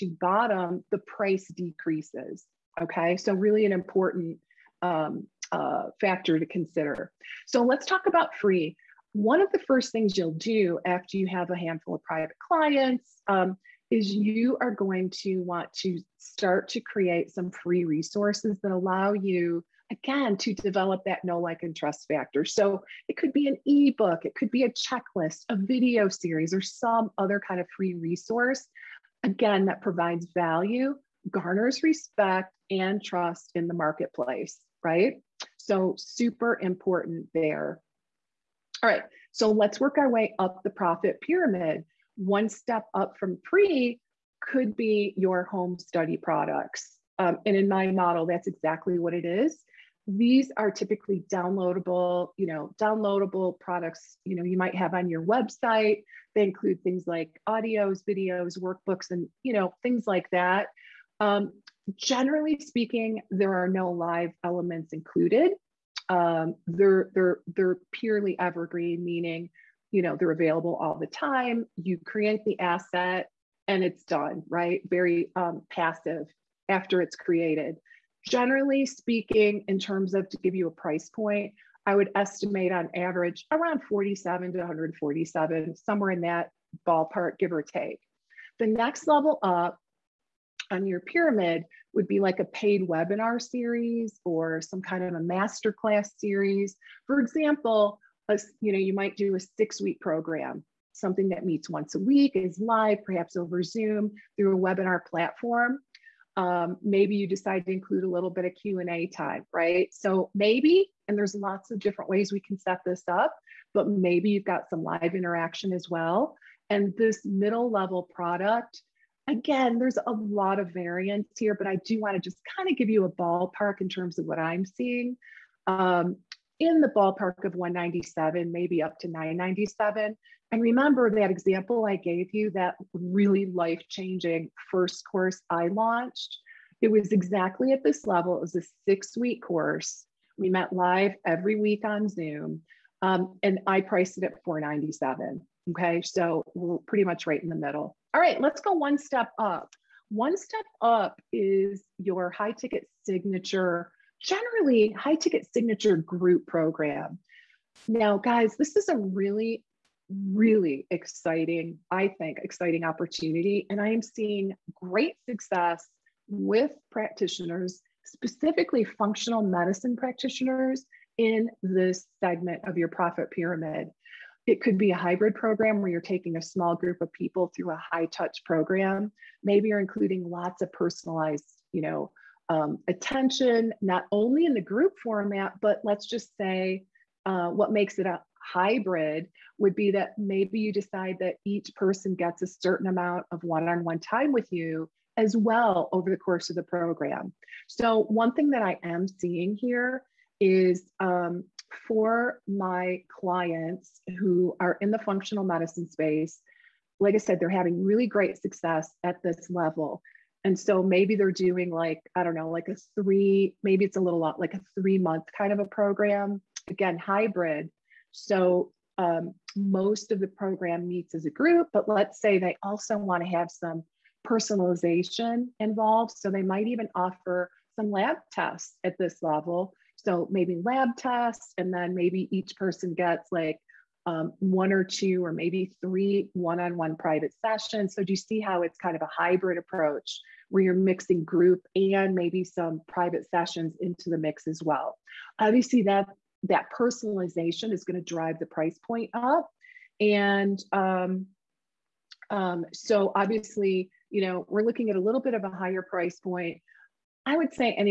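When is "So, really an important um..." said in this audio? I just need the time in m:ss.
0:03.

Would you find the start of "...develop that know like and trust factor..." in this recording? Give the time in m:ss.
0:20.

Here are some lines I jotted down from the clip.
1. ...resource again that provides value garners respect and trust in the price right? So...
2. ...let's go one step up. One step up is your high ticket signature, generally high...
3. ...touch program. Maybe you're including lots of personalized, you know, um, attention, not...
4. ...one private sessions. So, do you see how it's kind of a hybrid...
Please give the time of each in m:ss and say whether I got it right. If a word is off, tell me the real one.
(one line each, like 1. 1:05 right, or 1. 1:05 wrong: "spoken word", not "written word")
1. 0:27 wrong: "marketplace", not "price"
2. 2:28 right
3. 2:58 right
4. 3:56 right.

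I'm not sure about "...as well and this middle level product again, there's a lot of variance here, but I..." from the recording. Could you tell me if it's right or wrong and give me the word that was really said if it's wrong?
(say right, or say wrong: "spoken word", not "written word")
right.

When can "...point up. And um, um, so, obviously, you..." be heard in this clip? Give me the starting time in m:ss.
4:08.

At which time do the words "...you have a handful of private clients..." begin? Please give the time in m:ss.
0:11.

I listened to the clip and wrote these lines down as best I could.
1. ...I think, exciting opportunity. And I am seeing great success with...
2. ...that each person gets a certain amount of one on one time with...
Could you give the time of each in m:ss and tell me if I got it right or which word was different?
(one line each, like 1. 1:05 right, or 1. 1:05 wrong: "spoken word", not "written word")
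1. 2:41 right
2. 3:11 right.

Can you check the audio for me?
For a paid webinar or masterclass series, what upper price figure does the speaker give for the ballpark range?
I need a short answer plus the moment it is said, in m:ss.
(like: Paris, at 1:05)
$997, at 2:09.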